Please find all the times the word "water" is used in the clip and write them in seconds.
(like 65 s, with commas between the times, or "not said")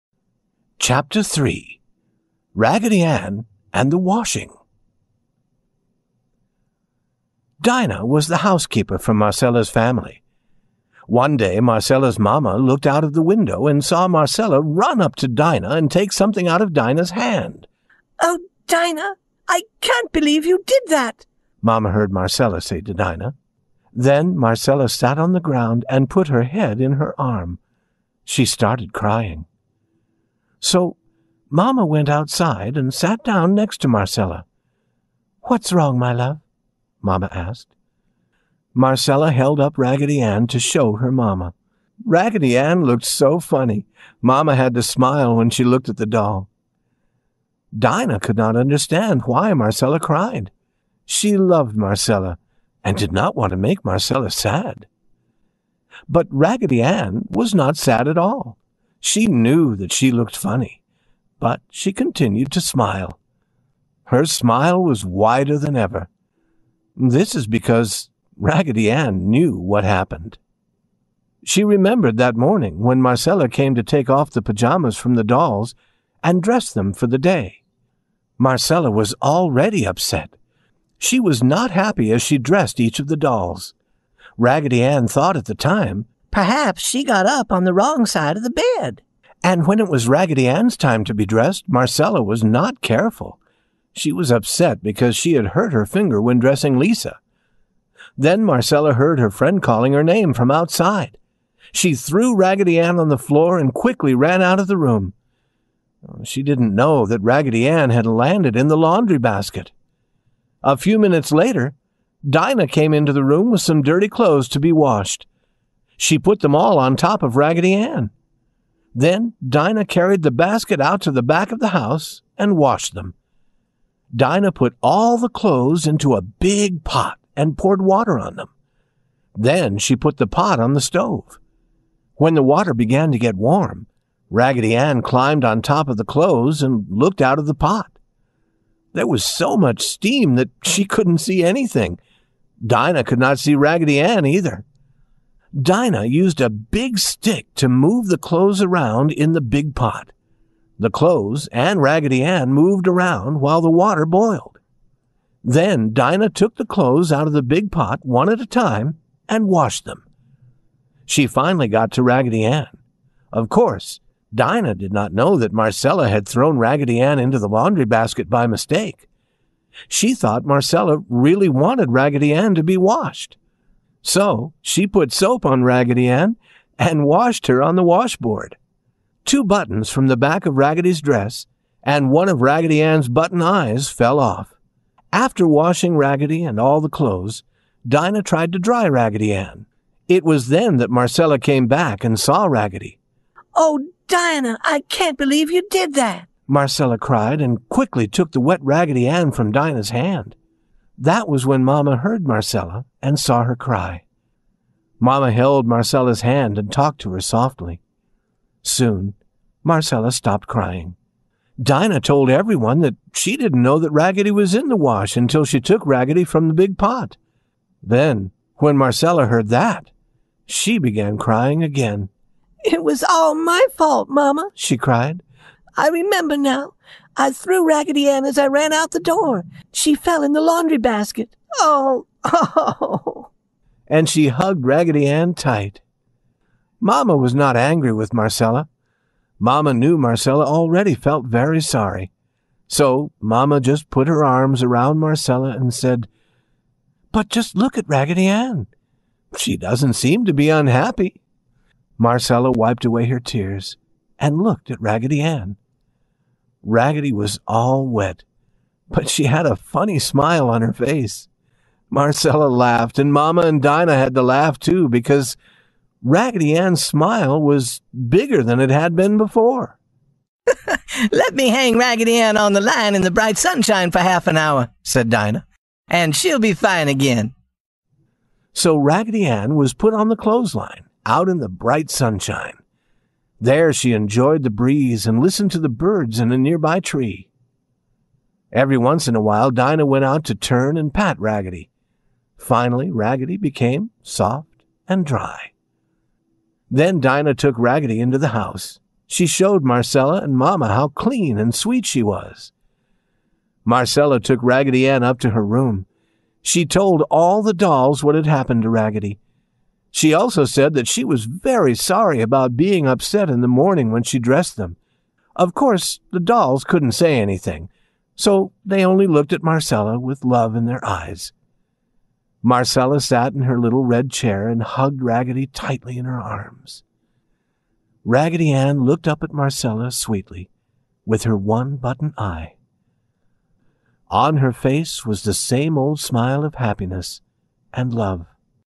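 127 s, 132 s, 153 s.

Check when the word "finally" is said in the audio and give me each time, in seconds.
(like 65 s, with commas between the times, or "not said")
161 s, 292 s.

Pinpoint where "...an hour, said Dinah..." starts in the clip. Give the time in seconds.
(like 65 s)
274 s.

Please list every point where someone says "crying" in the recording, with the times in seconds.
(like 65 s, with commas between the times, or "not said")
28 s, 210 s, 221 s.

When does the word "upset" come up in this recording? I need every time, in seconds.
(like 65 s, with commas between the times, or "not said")
79 s, 94 s, 312 s.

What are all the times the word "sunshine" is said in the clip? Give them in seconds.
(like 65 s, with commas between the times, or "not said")
273 s, 281 s.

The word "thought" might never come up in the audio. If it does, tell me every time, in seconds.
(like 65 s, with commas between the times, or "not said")
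85 s, 170 s.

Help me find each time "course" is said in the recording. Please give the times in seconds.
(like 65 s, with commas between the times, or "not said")
163 s, 315 s.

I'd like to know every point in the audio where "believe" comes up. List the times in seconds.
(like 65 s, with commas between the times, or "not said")
20 s, 195 s.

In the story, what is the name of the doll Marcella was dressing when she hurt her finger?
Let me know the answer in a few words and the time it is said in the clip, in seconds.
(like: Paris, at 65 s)
Lisa, at 96 s.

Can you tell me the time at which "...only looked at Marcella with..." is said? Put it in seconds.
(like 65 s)
318 s.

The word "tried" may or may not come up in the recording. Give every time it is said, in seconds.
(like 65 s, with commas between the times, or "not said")
188 s.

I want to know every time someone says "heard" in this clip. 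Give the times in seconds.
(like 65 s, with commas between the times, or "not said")
21 s, 98 s, 201 s, 219 s.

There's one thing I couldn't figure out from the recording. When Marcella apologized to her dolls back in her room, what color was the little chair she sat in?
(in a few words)
Red.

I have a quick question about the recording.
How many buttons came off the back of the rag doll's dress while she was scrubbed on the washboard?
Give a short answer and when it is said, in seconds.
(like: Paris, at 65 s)
2, at 179 s.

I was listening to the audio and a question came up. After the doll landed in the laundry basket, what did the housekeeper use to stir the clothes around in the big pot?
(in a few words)
A big stick.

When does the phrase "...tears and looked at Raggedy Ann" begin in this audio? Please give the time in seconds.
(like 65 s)
253 s.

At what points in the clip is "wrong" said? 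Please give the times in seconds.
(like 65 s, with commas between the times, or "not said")
35 s, 87 s.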